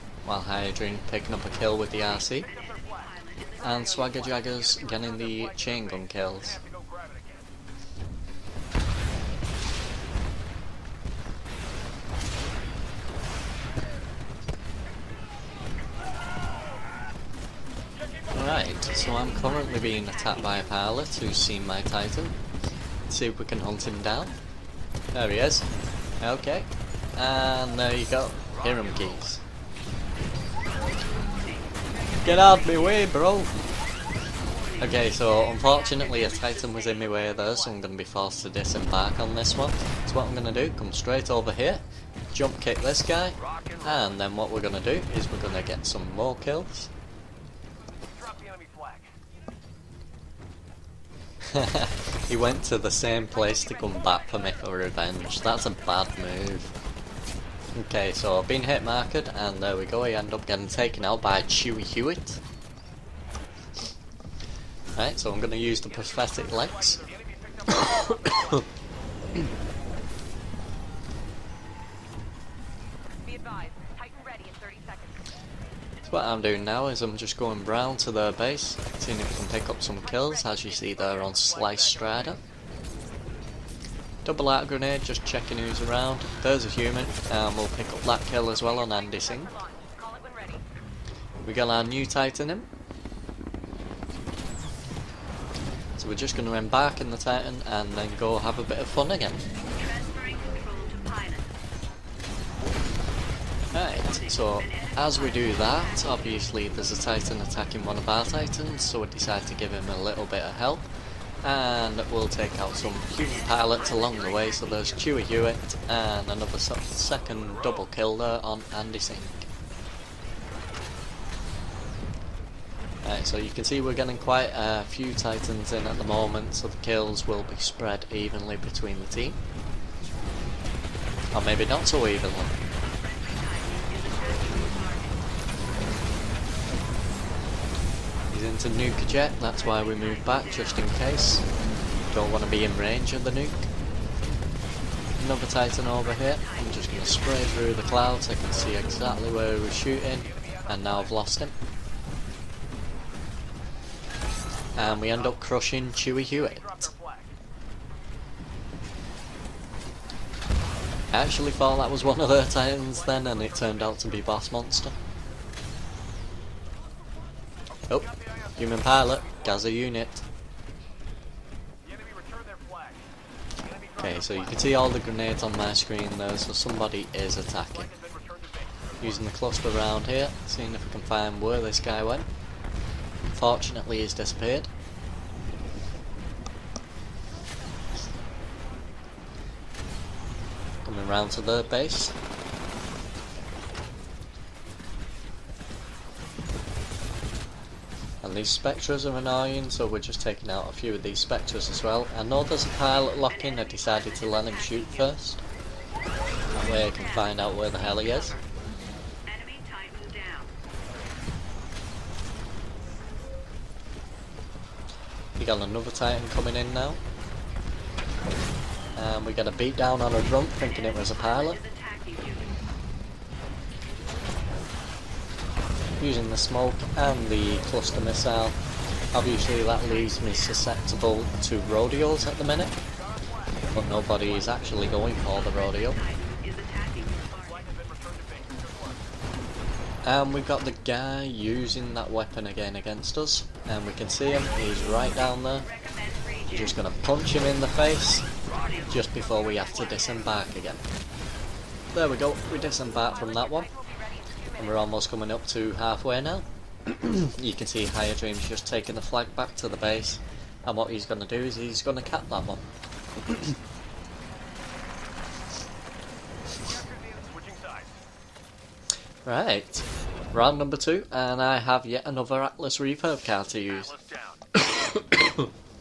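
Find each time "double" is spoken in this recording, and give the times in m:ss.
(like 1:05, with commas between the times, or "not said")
1:24, 1:57.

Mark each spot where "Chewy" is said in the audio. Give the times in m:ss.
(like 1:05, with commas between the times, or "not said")
1:01, 1:54, 2:35.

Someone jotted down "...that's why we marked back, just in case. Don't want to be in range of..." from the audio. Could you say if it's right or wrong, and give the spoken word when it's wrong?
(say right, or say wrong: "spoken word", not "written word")
wrong: "moved", not "marked".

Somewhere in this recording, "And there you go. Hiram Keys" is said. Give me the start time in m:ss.
0:27.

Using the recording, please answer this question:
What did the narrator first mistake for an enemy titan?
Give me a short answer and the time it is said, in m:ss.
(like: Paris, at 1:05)
Boss Monster, at 2:44.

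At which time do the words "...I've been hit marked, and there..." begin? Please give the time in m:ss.
0:58.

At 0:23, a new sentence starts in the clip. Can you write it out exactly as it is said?
Let's see if we can hunt him down.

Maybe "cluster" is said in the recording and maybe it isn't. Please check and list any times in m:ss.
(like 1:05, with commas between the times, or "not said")
2:59, 3:47.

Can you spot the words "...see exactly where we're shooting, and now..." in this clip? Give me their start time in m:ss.
2:28.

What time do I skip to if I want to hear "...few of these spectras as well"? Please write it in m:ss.
3:20.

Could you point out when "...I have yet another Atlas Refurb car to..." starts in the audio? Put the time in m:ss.
4:31.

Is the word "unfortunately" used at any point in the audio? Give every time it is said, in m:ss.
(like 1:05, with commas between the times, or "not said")
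0:35, 3:03.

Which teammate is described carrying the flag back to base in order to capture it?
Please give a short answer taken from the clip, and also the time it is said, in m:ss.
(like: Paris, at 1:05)
Higher Dreams, at 4:17.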